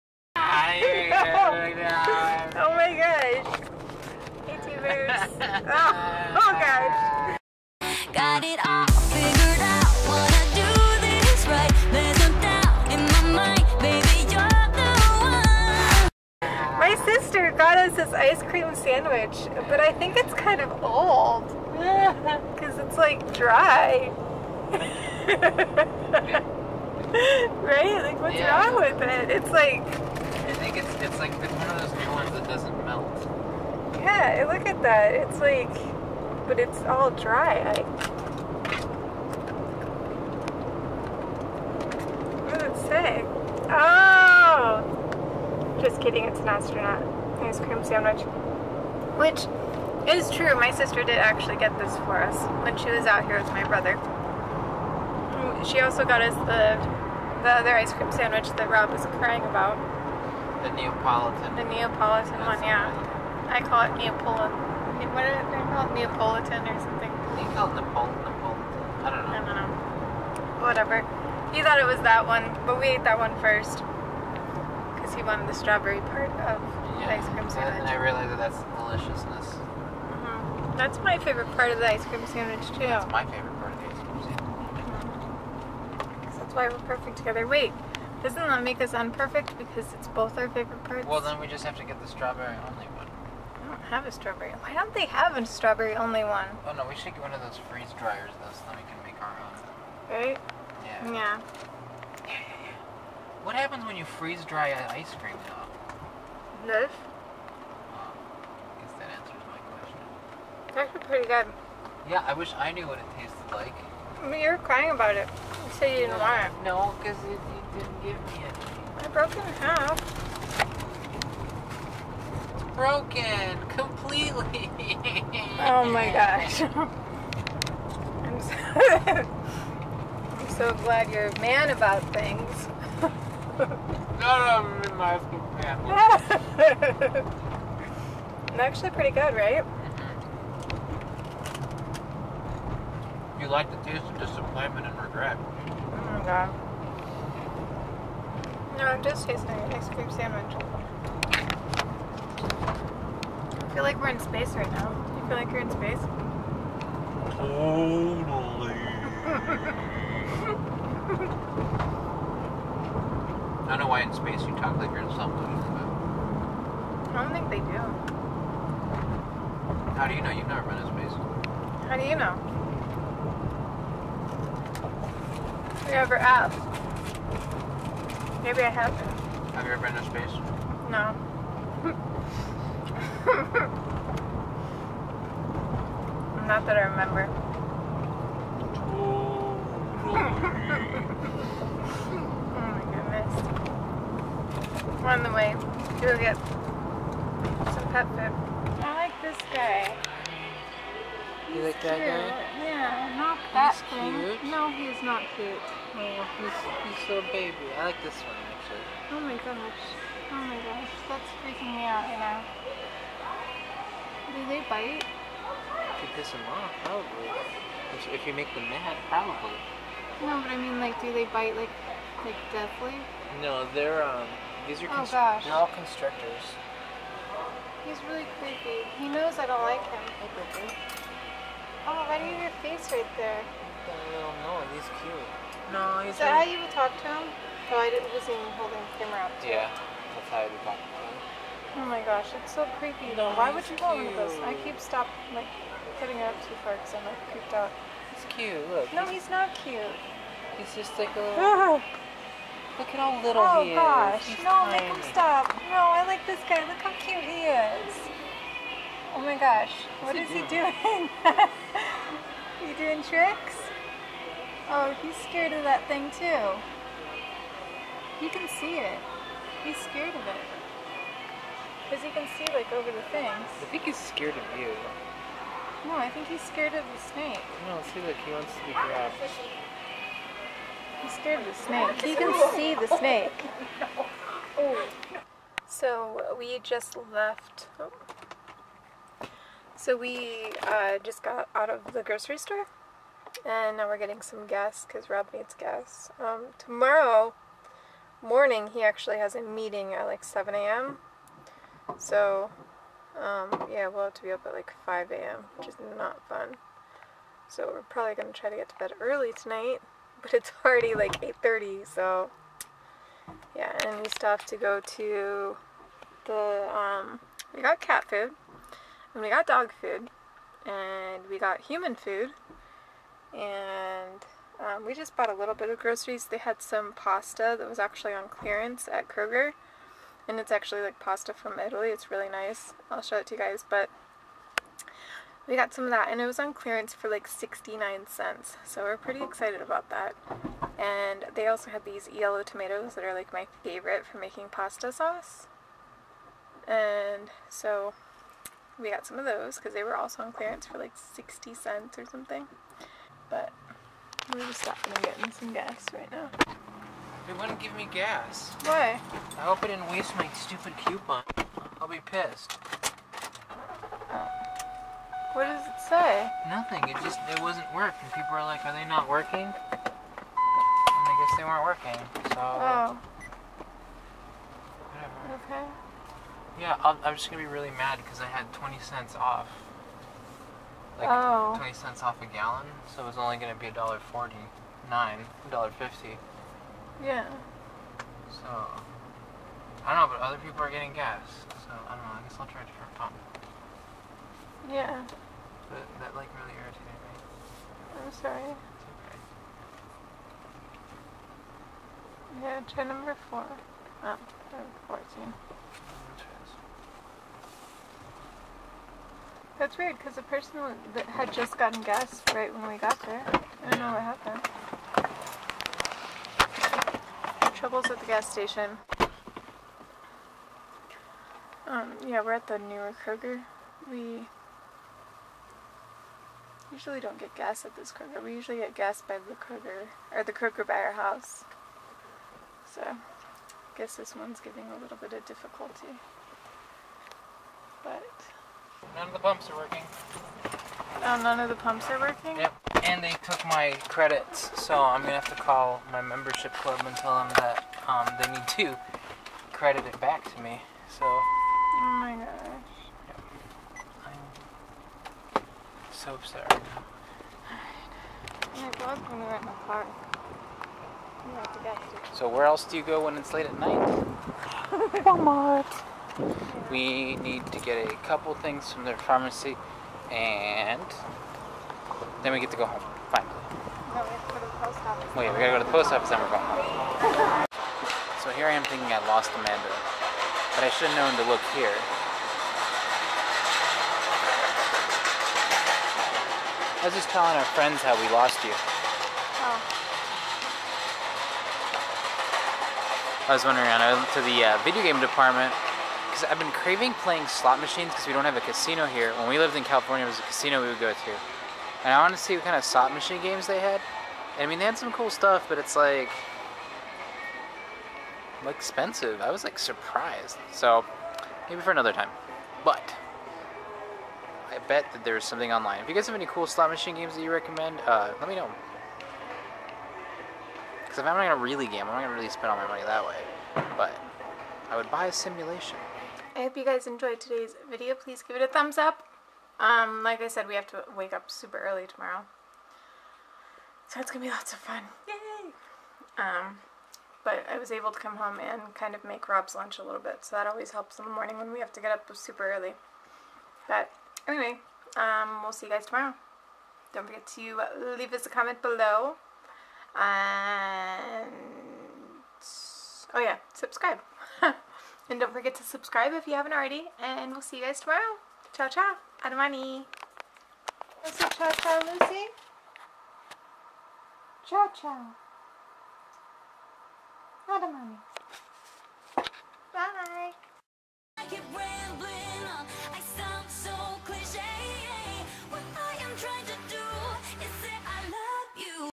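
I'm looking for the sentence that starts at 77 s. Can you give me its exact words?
And I realized that that's the deliciousness.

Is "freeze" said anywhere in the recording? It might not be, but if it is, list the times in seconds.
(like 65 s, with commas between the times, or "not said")
97 s, 104 s.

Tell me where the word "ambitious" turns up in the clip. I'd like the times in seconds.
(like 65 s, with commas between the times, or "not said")
not said.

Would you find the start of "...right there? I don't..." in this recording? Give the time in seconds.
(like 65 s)
232 s.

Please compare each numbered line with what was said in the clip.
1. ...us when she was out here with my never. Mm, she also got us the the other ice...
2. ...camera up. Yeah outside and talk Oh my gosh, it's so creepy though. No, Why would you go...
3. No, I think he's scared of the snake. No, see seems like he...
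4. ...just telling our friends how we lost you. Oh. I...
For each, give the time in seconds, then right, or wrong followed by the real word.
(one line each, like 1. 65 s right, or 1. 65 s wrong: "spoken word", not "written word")
1. 52 s wrong: "brother", not "never"
2. 239 s right
3. 275 s right
4. 486 s right.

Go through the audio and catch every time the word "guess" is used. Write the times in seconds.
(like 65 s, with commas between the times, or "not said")
108 s, 371 s, 392 s, 433 s.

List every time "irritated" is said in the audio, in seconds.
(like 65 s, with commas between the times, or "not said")
396 s.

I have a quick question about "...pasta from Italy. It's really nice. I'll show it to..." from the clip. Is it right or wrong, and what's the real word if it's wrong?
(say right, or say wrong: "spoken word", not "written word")
right.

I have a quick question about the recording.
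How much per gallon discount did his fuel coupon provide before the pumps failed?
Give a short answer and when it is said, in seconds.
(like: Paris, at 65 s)
20 cents, at 381 s.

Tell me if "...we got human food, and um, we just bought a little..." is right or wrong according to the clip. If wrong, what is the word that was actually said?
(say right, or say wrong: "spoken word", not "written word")
right.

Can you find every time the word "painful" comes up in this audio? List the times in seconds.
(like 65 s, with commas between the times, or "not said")
not said.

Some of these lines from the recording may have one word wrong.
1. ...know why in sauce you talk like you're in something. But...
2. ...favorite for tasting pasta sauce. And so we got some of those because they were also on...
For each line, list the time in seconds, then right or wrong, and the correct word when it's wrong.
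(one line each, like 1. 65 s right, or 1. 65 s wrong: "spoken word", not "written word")
1. 163 s wrong: "space", not "sauce"
2. 343 s wrong: "making", not "tasting".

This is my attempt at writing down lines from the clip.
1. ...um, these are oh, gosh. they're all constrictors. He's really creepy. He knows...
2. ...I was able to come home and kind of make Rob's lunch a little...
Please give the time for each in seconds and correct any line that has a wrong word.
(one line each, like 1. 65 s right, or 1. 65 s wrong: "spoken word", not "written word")
1. 224 s right
2. 537 s right.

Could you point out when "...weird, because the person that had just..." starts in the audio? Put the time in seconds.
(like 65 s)
409 s.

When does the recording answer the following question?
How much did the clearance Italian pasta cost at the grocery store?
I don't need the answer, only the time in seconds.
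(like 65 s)
337 s.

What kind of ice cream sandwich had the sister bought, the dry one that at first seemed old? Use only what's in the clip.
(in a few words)
astronaut ice cream sandwich.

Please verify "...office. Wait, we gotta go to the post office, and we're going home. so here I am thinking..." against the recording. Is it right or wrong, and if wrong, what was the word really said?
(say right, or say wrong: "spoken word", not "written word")
right.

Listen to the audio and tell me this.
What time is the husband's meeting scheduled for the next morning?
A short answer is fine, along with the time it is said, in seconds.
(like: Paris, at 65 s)
7 a.m., at 300 s.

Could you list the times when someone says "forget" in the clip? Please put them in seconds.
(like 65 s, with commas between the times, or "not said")
547 s, 555 s.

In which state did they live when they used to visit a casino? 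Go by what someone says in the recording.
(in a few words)
California.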